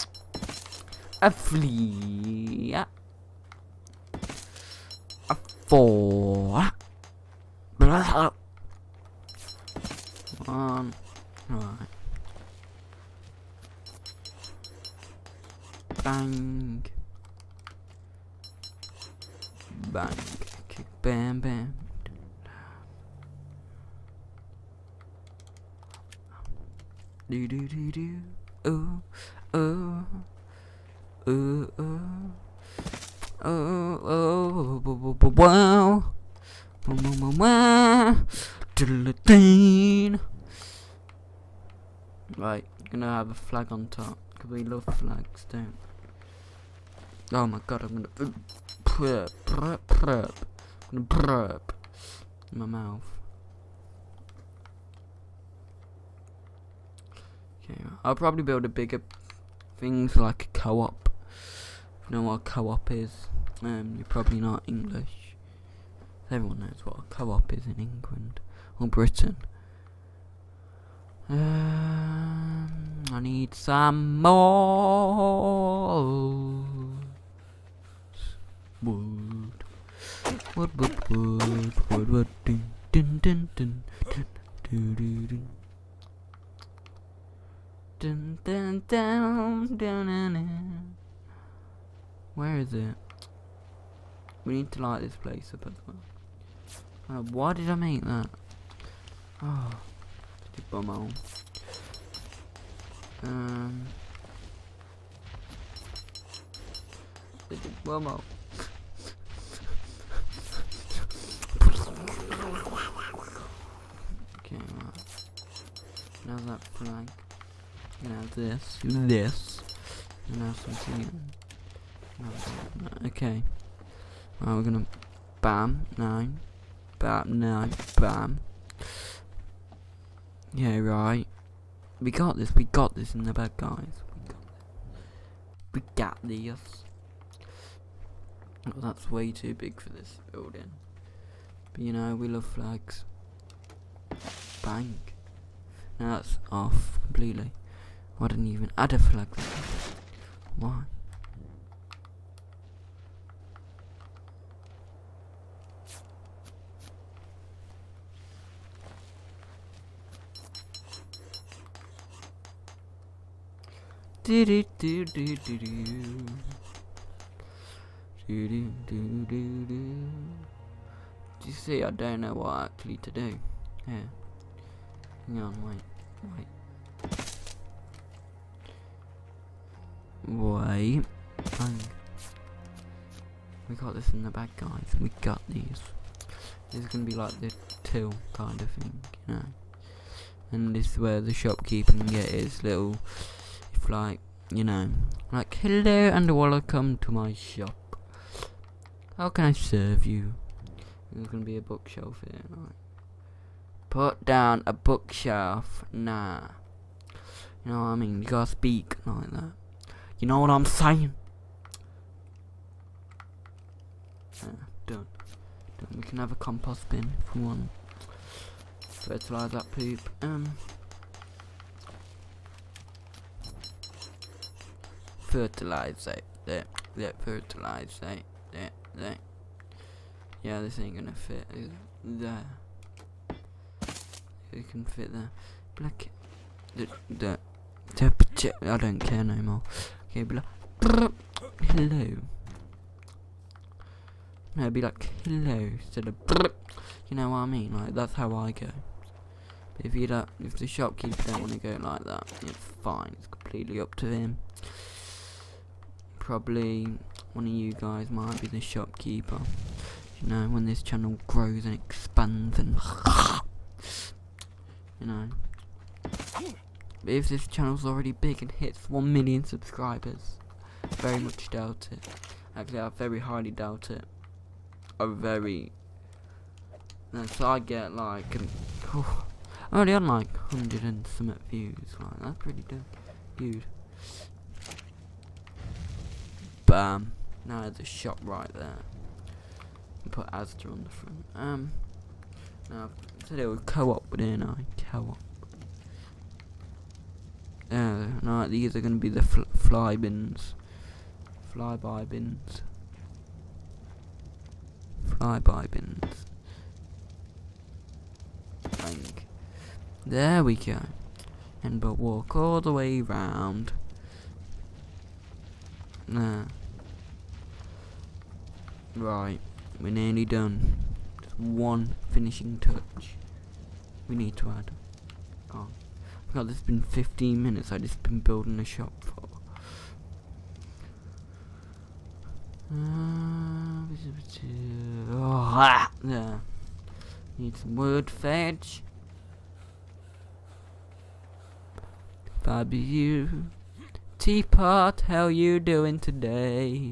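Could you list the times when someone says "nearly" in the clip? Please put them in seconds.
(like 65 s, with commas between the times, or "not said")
319 s.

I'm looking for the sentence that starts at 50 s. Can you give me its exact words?
I'm gonna burp in my mouth.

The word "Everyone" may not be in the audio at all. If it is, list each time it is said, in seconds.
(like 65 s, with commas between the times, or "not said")
66 s.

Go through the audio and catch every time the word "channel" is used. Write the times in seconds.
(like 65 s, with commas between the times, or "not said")
260 s, 267 s.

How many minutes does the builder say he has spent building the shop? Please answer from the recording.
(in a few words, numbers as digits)
15.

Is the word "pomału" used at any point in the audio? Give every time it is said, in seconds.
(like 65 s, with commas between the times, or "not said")
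100 s, 107 s.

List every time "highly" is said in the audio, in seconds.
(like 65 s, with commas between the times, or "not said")
273 s.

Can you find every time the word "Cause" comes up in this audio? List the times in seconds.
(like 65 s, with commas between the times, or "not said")
44 s.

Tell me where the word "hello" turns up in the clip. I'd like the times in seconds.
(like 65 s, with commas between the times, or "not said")
195 s, 240 s, 245 s.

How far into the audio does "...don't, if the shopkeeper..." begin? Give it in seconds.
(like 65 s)
250 s.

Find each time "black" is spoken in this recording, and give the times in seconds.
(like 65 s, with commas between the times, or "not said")
235 s, 240 s.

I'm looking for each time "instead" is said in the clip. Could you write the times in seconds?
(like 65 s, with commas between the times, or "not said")
245 s.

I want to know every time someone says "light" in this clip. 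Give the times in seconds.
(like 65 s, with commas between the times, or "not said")
94 s.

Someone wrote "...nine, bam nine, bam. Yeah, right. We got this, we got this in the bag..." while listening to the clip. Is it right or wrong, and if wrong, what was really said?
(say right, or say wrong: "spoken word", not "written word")
right.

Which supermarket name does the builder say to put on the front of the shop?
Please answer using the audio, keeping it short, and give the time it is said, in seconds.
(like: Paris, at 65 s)
Asda, at 290 s.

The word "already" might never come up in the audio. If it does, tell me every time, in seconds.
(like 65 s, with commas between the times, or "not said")
267 s, 279 s.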